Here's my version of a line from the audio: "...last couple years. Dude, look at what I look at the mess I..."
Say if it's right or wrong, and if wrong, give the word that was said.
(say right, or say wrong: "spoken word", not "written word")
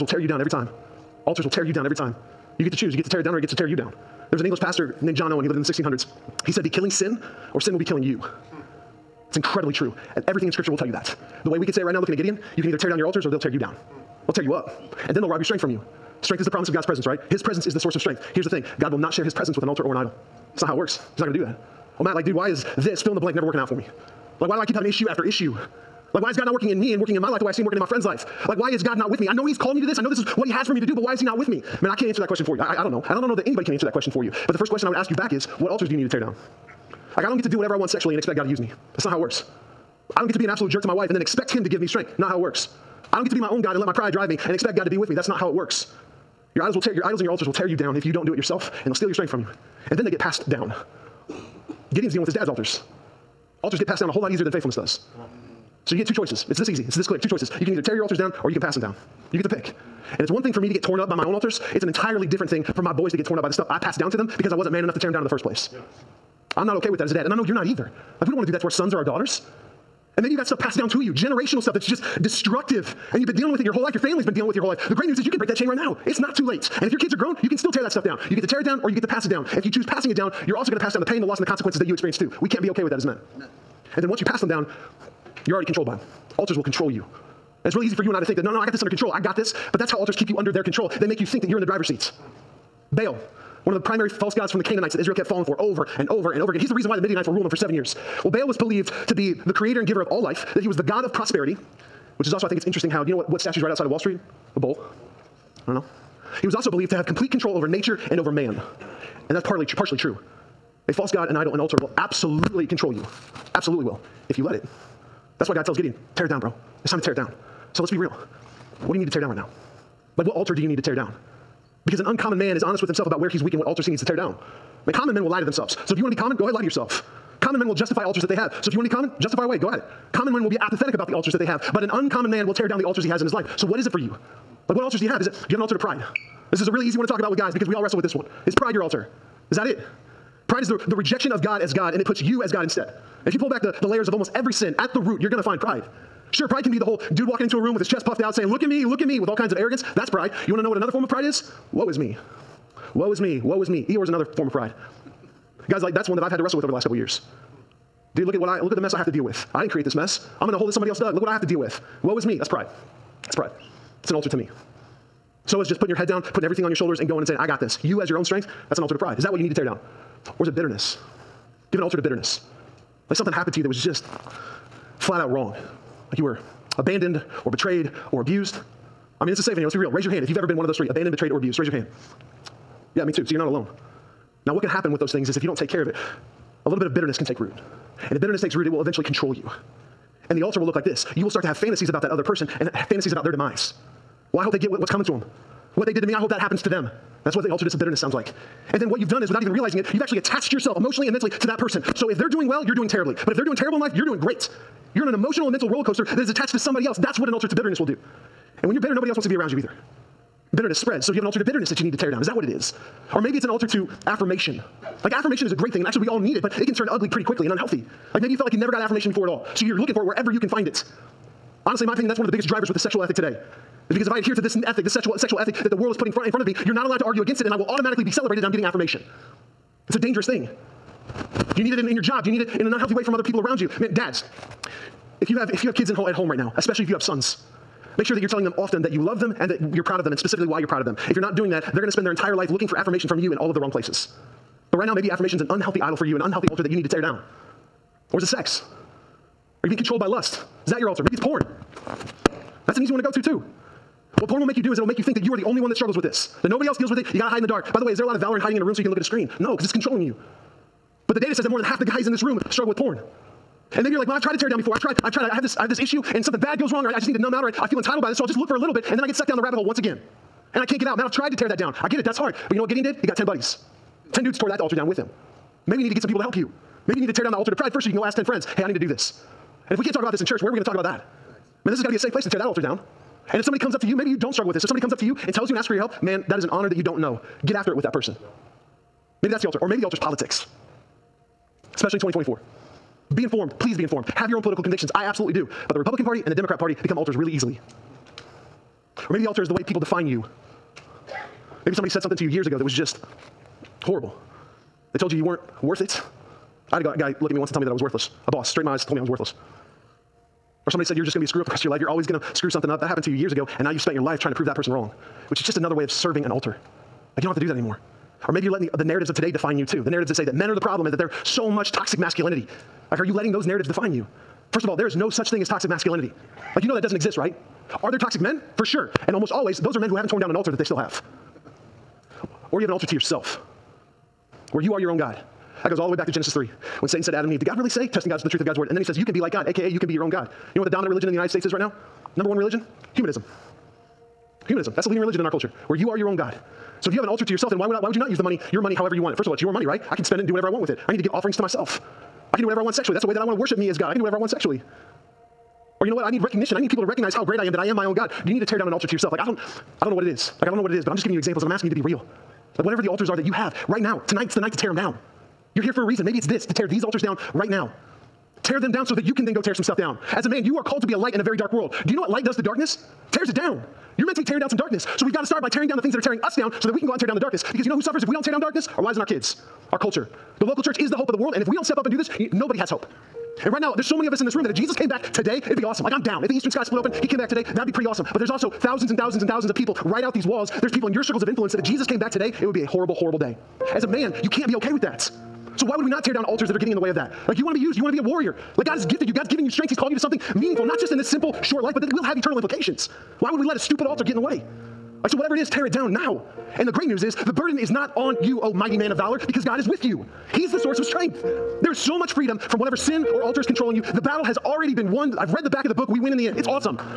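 right.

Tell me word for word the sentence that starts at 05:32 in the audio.
Or do you have an altar to yourself where you are your own God?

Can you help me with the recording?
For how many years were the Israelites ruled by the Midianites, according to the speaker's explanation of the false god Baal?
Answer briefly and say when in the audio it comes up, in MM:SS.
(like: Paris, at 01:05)
7, at 01:37.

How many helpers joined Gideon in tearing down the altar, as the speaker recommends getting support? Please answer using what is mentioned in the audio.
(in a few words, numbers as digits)
10.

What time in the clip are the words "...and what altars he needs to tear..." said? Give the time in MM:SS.
02:03.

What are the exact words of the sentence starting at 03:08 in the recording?
And if bitterness takes root, it will eventually control you.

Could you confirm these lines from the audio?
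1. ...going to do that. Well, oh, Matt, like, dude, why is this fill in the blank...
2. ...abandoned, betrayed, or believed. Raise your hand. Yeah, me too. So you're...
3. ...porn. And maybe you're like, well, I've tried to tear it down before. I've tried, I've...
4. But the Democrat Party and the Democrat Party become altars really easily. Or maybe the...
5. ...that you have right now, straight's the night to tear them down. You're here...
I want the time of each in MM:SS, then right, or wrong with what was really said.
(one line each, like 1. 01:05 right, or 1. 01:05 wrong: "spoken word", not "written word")
1. 00:21 right
2. 03:00 wrong: "abused", not "believed"
3. 04:22 right
4. 04:55 wrong: "Republican", not "Democrat"
5. 06:03 wrong: "tonight", not "straight".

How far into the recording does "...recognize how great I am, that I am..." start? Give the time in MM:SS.
05:56.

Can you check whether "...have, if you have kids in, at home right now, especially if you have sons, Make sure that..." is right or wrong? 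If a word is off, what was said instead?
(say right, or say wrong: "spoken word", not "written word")
right.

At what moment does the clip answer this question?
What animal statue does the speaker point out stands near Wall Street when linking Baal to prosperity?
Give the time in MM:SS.
01:44.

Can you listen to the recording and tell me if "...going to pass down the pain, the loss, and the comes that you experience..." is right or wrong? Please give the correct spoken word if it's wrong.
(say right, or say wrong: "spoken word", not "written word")
wrong: "consequences", not "comes".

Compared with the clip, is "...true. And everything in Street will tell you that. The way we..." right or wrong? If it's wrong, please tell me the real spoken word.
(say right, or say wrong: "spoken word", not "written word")
wrong: "Scripture", not "Street".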